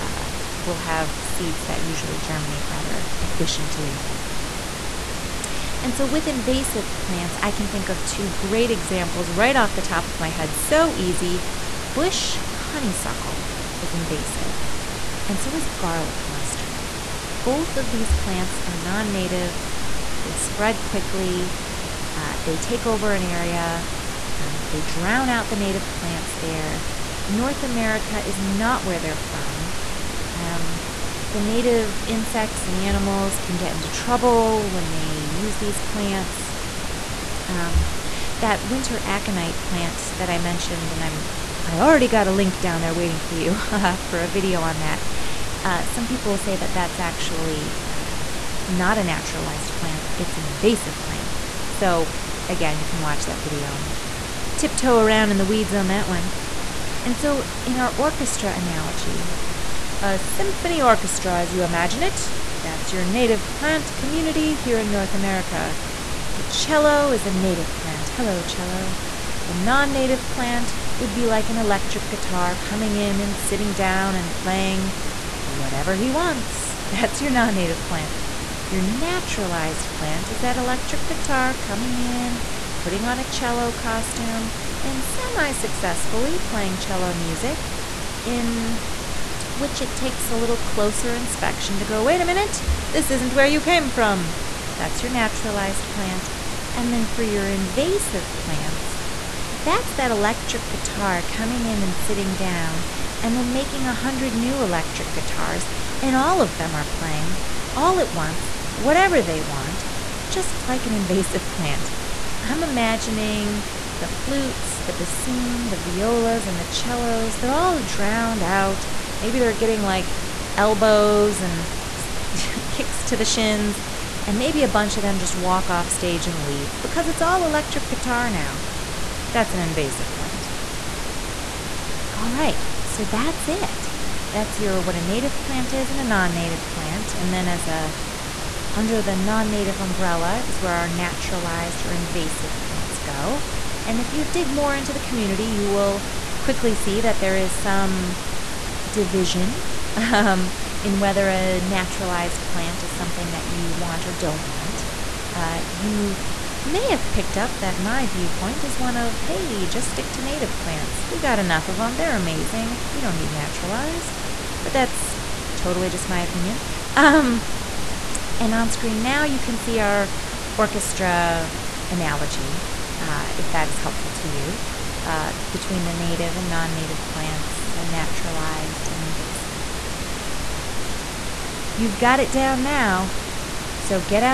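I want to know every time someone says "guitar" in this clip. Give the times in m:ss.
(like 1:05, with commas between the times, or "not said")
1:12, 1:21, 1:40, 1:45, 2:07.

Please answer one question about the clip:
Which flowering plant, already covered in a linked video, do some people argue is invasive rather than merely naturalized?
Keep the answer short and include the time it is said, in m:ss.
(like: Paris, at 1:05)
Winter aconite, at 0:38.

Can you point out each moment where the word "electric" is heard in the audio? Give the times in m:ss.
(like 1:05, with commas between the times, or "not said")
1:11, 1:20, 1:40, 1:44, 2:07.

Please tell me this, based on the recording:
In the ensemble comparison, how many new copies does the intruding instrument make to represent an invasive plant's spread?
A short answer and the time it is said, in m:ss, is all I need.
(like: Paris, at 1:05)
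100, at 1:43.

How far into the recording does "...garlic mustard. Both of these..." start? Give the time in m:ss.
0:15.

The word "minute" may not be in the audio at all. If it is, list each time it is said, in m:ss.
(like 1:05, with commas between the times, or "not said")
1:32.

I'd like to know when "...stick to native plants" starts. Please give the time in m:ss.
2:39.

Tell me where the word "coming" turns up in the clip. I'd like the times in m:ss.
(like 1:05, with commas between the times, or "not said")
1:12, 1:21, 1:41.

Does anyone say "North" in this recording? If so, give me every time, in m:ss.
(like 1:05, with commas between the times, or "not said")
0:27, 1:04.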